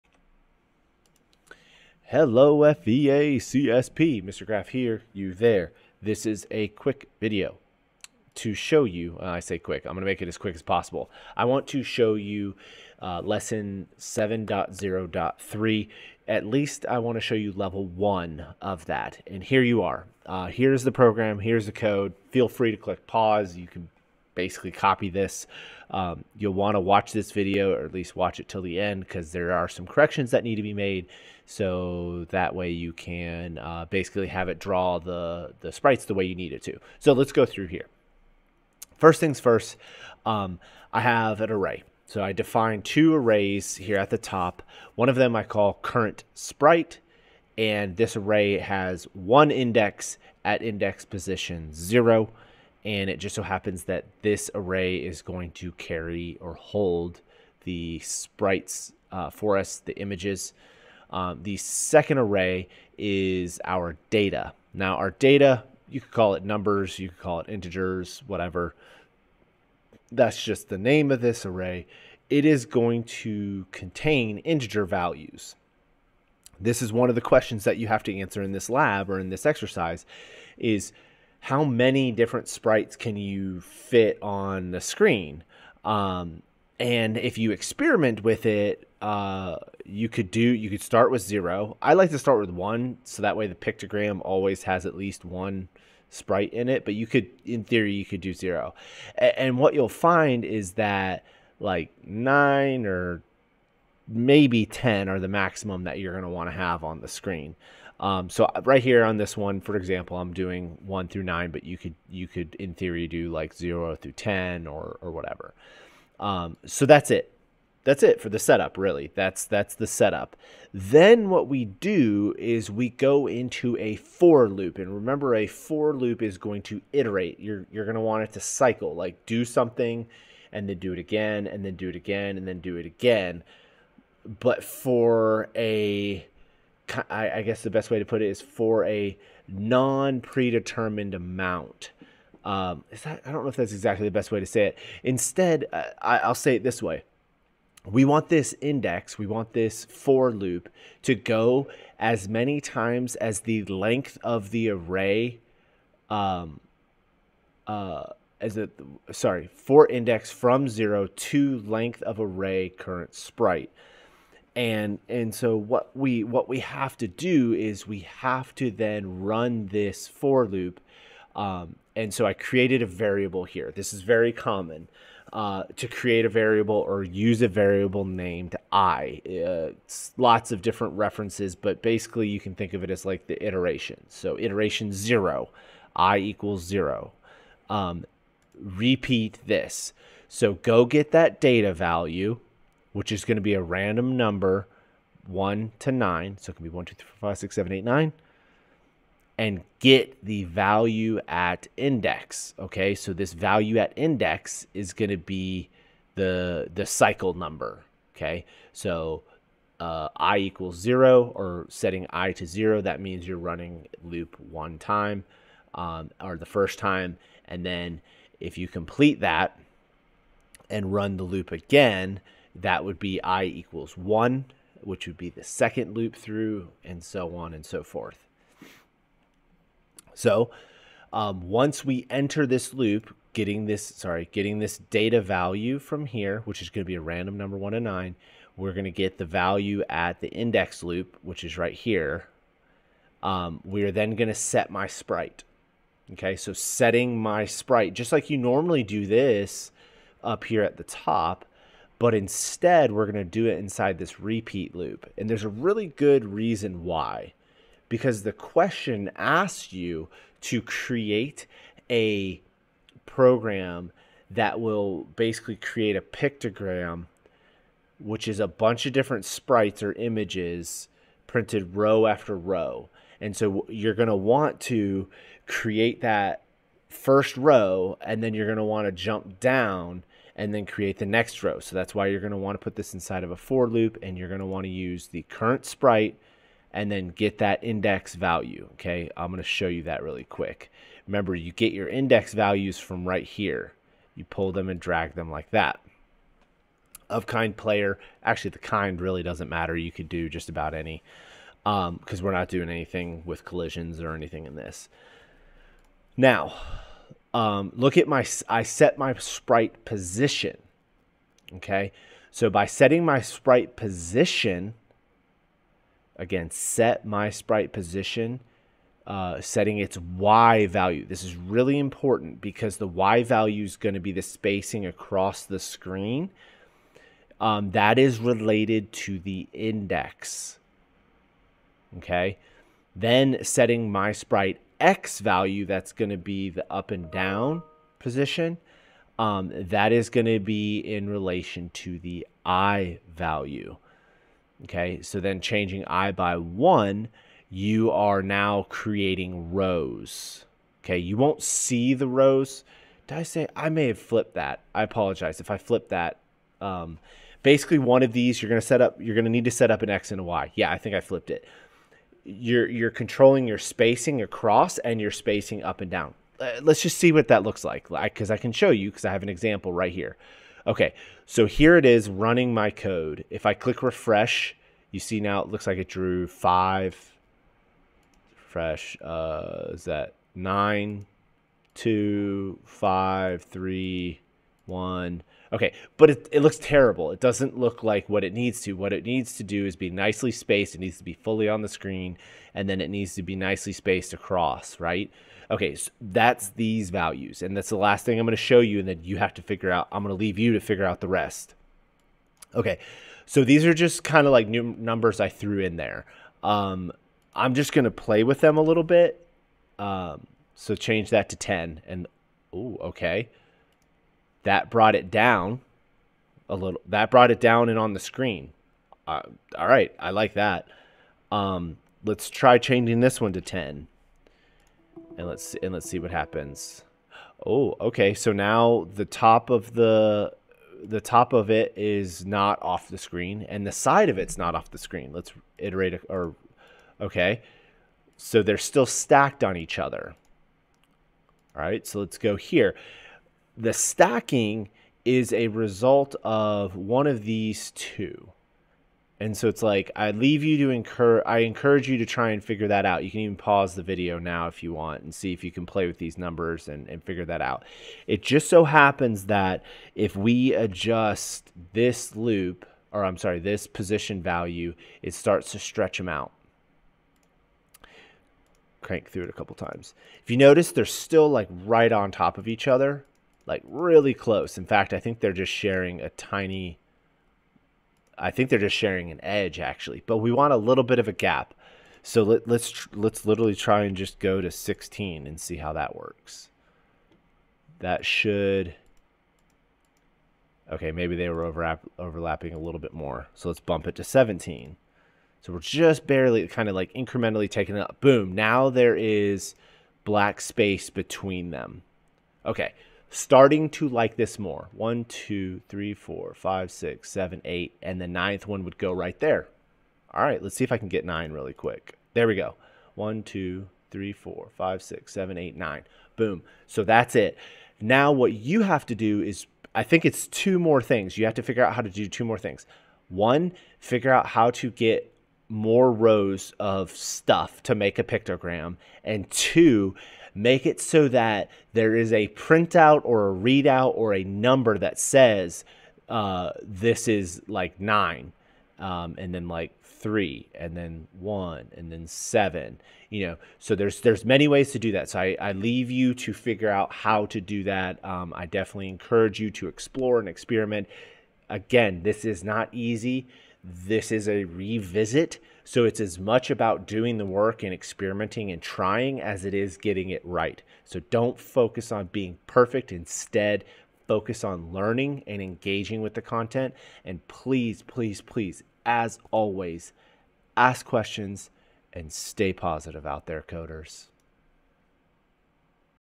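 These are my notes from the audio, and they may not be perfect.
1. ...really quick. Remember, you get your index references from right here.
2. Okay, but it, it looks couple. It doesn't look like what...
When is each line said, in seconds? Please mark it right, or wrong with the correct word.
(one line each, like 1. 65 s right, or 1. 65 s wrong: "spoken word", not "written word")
1. 290 s wrong: "values", not "references"
2. 385 s wrong: "terrible", not "couple".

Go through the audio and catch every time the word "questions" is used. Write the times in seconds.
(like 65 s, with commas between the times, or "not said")
77 s, 258 s, 570 s.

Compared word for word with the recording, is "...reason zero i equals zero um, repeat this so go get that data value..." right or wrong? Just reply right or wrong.
wrong.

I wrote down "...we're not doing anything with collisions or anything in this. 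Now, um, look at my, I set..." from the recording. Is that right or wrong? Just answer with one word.
right.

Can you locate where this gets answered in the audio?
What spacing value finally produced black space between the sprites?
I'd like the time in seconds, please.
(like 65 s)
493 s.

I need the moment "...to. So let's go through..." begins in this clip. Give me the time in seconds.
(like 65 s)
36 s.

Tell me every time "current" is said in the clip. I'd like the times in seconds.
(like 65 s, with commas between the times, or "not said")
45 s, 162 s, 285 s.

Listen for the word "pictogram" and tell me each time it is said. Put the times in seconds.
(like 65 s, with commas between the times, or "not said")
93 s, 266 s, 528 s.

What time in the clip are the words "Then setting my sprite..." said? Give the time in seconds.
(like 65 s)
332 s.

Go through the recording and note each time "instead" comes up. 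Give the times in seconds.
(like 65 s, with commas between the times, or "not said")
145 s, 252 s, 562 s.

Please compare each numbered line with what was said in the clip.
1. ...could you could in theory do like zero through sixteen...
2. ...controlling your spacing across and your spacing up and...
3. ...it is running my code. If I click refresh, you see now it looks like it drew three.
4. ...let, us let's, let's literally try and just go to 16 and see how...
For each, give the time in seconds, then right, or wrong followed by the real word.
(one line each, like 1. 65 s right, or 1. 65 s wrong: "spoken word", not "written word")
1. 111 s wrong: "ten", not "sixteen"
2. 362 s right
3. 371 s wrong: "five", not "three"
4. 482 s right.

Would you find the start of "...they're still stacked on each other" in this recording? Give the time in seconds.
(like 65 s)
438 s.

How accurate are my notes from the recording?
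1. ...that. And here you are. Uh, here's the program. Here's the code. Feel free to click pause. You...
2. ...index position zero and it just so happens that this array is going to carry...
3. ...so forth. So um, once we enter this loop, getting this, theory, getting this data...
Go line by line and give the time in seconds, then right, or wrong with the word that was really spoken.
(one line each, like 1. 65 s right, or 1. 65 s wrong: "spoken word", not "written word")
1. 18 s right
2. 50 s right
3. 227 s wrong: "sorry", not "theory".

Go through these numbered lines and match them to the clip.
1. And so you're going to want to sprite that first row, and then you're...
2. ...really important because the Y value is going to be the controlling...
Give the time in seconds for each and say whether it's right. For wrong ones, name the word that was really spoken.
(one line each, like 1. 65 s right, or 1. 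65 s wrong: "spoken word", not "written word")
1. 273 s wrong: "create", not "sprite"
2. 321 s wrong: "spacing", not "controlling".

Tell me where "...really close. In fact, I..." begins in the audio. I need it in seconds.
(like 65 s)
473 s.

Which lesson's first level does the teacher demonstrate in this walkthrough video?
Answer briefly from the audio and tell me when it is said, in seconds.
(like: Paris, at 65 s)
7.0.3, at 13 s.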